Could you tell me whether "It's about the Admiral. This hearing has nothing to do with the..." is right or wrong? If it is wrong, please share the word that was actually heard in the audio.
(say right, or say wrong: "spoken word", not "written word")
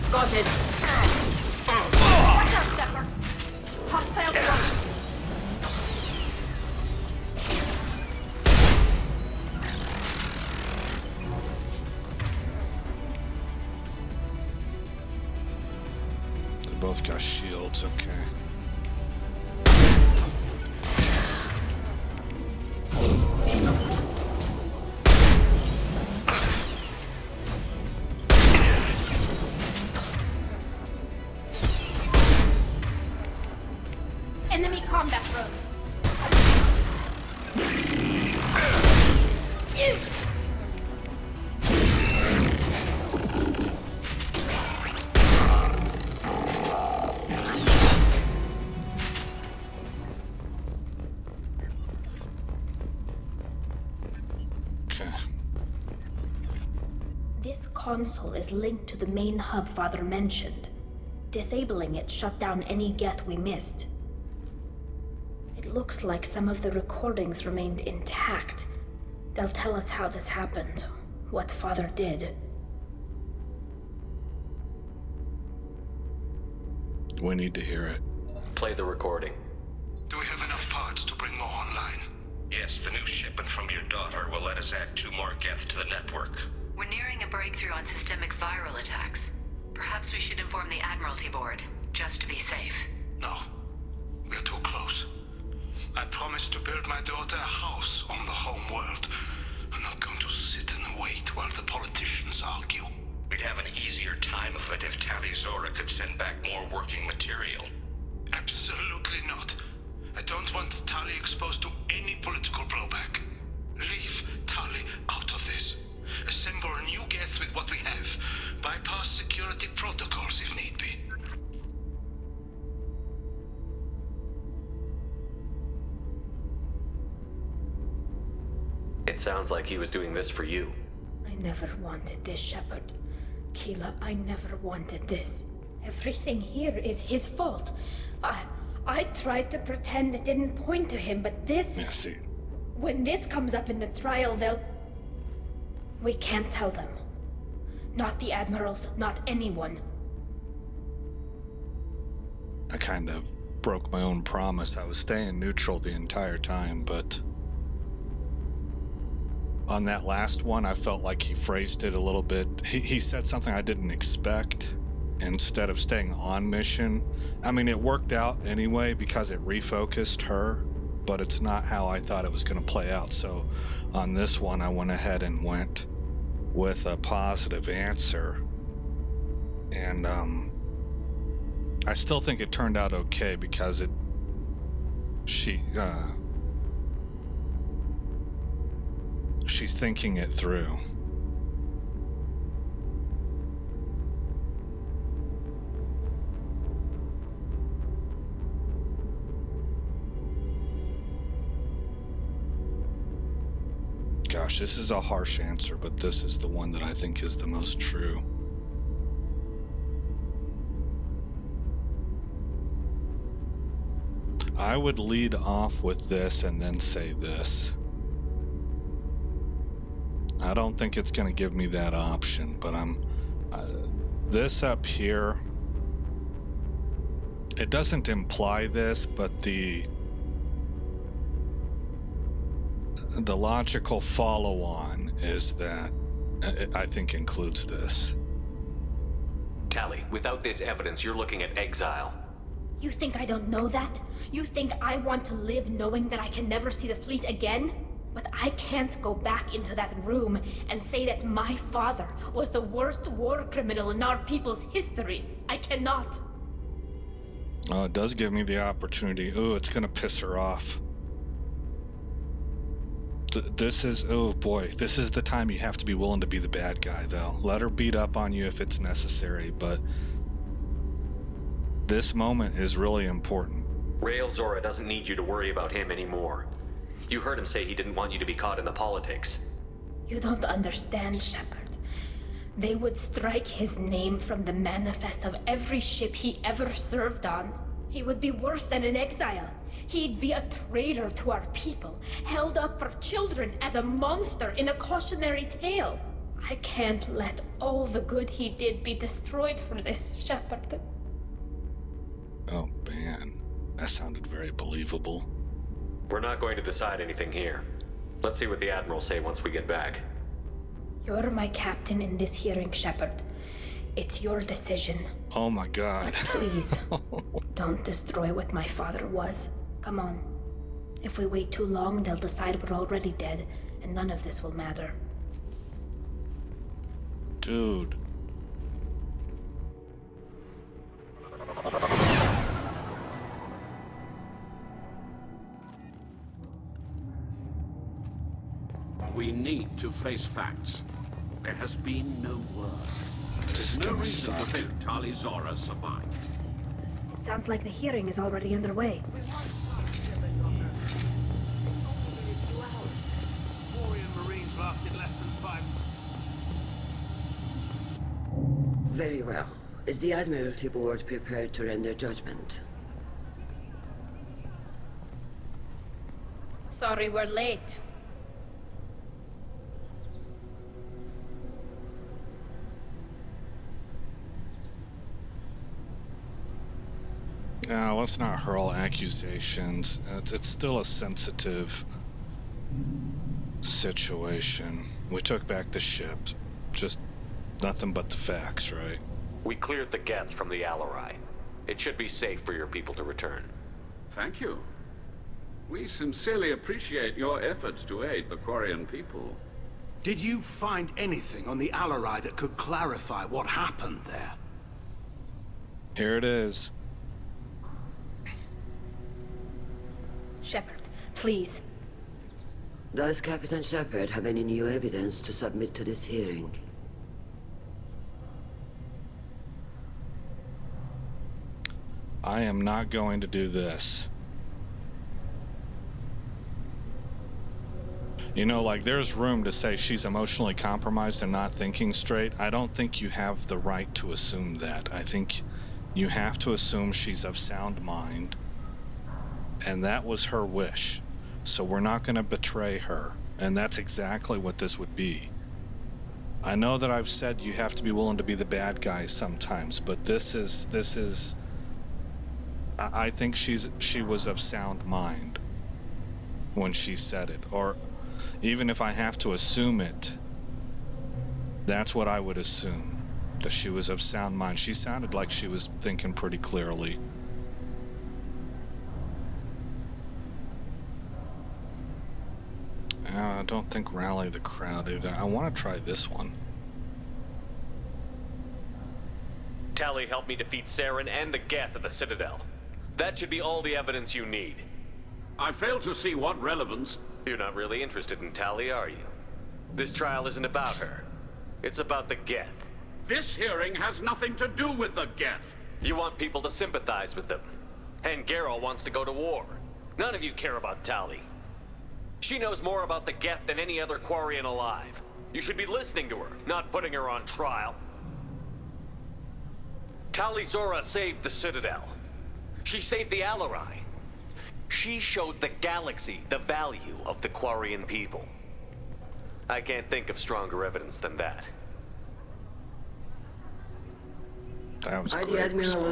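wrong: "Geth", not "Admiral".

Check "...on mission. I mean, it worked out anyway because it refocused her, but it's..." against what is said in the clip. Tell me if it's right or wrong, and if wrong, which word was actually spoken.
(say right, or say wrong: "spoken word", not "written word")
right.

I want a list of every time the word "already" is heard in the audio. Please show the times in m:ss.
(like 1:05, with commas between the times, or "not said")
5:22, 5:48.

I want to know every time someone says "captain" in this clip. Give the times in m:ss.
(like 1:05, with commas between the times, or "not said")
5:11, 6:53.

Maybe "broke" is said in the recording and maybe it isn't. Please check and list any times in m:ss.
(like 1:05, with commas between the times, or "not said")
2:33.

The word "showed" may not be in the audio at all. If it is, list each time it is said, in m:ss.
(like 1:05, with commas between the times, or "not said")
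8:34.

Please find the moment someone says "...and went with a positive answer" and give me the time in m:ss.
2:55.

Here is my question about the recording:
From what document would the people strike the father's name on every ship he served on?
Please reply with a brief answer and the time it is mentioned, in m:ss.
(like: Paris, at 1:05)
the manifest, at 4:44.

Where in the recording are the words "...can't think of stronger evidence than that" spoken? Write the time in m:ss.
8:39.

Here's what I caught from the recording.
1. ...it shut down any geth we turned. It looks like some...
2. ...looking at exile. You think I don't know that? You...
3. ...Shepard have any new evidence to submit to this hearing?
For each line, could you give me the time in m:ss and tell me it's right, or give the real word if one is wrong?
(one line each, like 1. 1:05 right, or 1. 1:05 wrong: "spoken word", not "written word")
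1. 1:01 wrong: "missed", not "turned"
2. 4:01 right
3. 6:53 right.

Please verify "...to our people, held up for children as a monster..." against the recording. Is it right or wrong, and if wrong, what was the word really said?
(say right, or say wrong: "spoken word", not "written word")
right.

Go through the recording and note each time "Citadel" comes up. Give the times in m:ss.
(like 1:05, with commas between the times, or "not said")
8:01, 8:31.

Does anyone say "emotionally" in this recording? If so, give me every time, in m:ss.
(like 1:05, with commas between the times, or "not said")
7:10.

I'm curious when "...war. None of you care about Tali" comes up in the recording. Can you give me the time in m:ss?
8:19.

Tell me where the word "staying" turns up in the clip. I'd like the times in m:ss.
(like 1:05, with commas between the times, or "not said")
2:34, 2:45.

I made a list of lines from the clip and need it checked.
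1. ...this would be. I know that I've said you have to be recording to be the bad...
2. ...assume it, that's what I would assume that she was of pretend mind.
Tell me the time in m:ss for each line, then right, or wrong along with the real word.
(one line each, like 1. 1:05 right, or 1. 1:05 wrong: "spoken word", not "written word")
1. 7:24 wrong: "willing", not "recording"
2. 7:39 wrong: "sound", not "pretend".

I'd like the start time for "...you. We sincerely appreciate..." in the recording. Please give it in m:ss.
6:34.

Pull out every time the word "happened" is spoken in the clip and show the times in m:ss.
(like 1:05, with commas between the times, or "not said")
1:10, 6:43.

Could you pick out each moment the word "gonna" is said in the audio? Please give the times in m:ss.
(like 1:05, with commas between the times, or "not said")
4:19.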